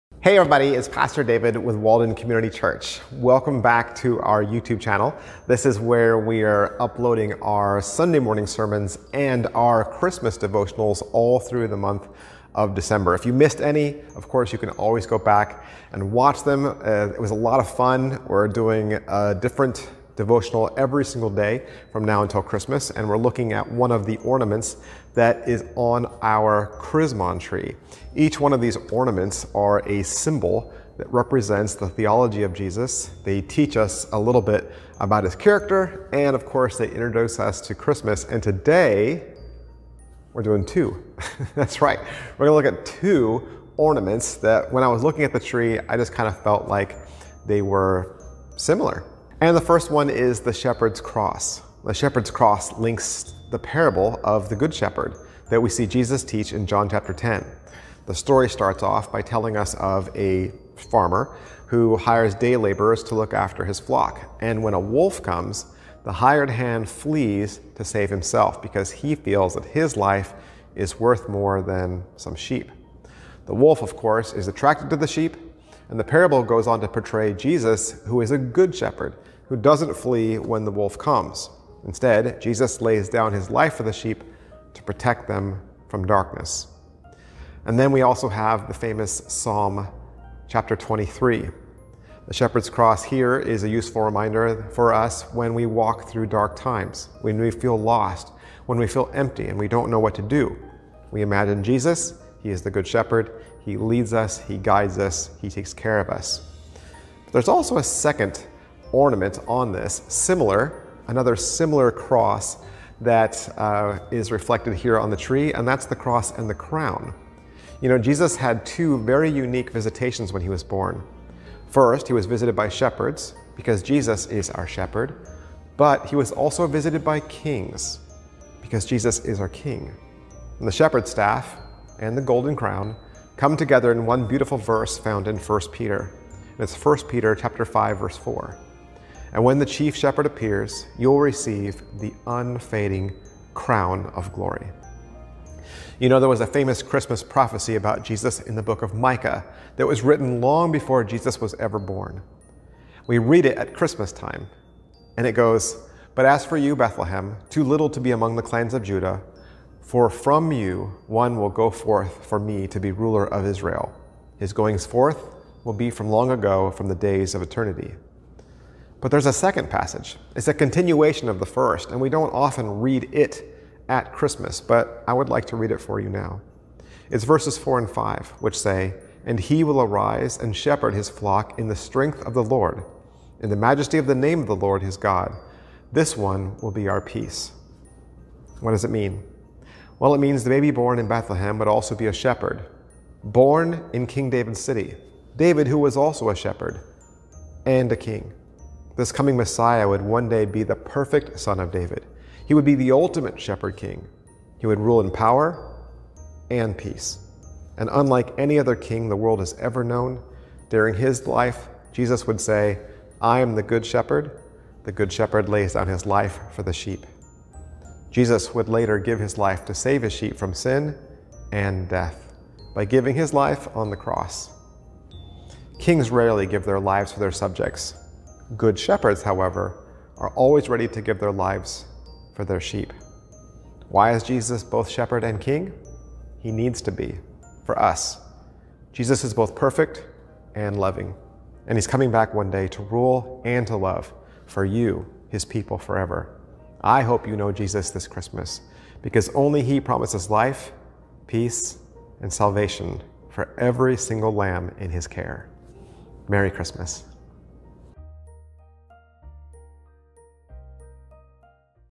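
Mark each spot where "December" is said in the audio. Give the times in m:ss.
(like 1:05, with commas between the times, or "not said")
0:12.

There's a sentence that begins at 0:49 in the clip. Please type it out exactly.
And the first one is the shepherd's cross.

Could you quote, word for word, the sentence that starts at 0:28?
Each one of these ornaments are a symbol that represents the theology of Jesus.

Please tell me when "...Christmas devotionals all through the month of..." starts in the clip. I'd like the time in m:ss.
0:09.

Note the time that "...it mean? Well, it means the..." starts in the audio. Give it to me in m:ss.
3:08.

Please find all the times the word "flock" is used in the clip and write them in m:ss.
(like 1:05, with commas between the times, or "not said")
1:03, 3:01.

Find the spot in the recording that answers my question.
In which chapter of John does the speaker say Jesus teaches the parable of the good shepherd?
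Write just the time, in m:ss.
0:56.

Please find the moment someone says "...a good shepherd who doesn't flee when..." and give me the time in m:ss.
1:18.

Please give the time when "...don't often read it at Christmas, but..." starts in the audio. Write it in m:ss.
2:52.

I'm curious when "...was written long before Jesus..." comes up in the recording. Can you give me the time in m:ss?
2:29.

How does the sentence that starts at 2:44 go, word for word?
His goings forth will be from long ago, from the days of eternity.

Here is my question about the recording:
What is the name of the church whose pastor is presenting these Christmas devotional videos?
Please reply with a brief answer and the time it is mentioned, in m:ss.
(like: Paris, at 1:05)
Walden Community Church, at 0:01.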